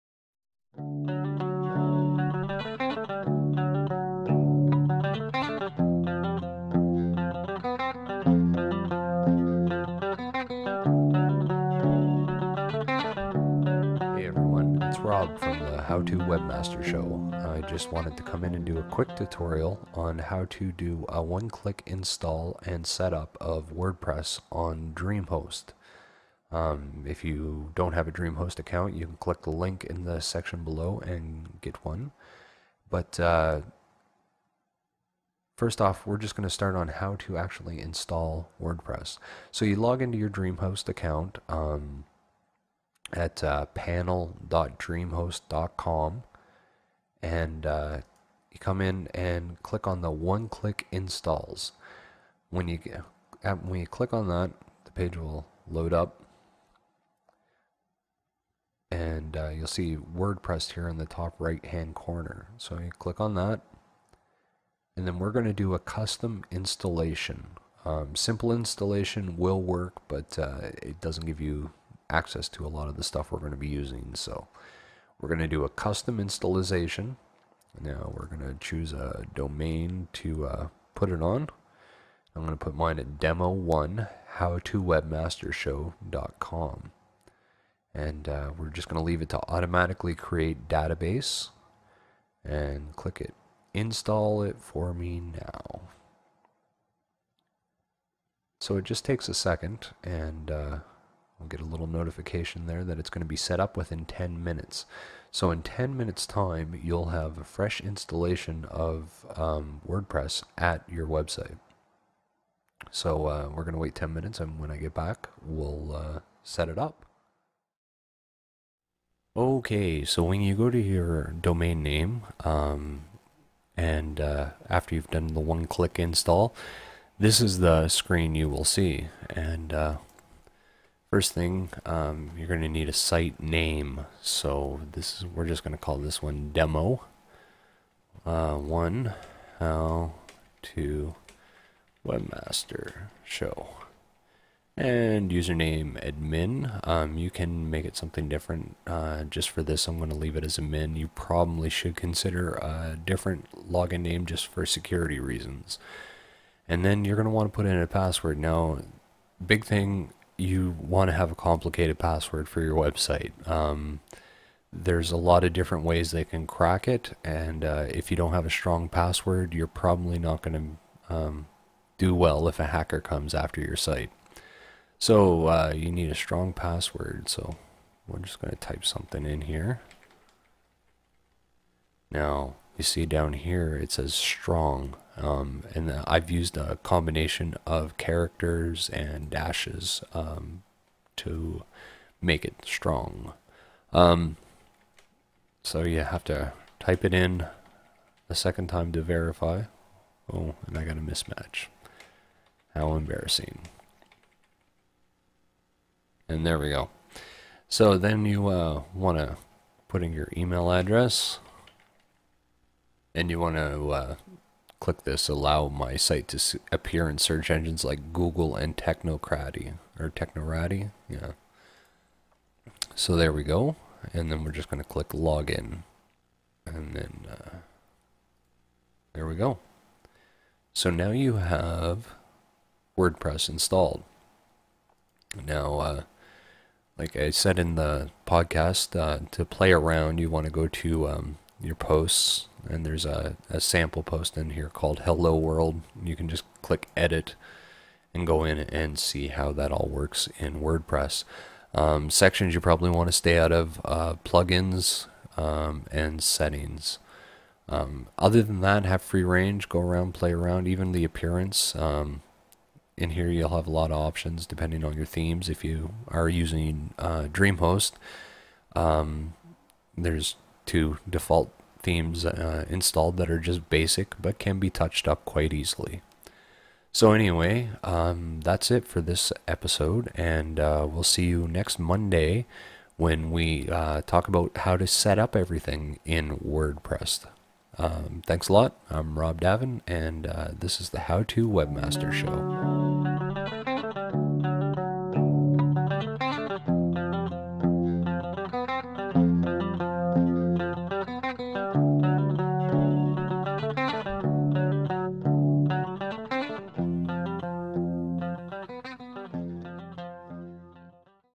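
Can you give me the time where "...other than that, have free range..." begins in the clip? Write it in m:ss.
4:18.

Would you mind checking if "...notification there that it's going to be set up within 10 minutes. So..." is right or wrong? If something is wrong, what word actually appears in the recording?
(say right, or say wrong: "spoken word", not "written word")
right.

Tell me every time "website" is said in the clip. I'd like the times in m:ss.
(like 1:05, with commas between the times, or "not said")
1:51, 2:42.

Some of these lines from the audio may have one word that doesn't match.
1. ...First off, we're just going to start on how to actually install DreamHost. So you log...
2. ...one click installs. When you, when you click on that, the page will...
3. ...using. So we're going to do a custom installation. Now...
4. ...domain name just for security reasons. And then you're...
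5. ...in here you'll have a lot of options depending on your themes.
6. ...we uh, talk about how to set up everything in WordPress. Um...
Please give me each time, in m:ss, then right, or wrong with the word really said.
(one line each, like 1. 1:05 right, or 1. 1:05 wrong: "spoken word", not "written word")
1. 0:35 wrong: "WordPress", not "DreamHost"
2. 0:50 right
3. 1:13 right
4. 2:33 wrong: "login", not "domain"
5. 4:22 right
6. 4:43 right.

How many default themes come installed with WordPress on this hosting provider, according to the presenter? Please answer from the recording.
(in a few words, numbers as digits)
2.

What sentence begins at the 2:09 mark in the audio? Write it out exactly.
And uh, First thing, um, you're going to need a site name.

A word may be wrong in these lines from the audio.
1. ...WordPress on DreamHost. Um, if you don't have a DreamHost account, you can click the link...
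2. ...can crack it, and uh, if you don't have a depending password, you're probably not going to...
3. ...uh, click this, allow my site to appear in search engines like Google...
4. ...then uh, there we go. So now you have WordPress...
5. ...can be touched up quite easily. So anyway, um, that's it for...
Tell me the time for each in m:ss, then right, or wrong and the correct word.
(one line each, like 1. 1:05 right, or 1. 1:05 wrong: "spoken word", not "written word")
1. 0:23 right
2. 2:46 wrong: "strong", not "depending"
3. 3:33 right
4. 3:46 right
5. 4:34 right.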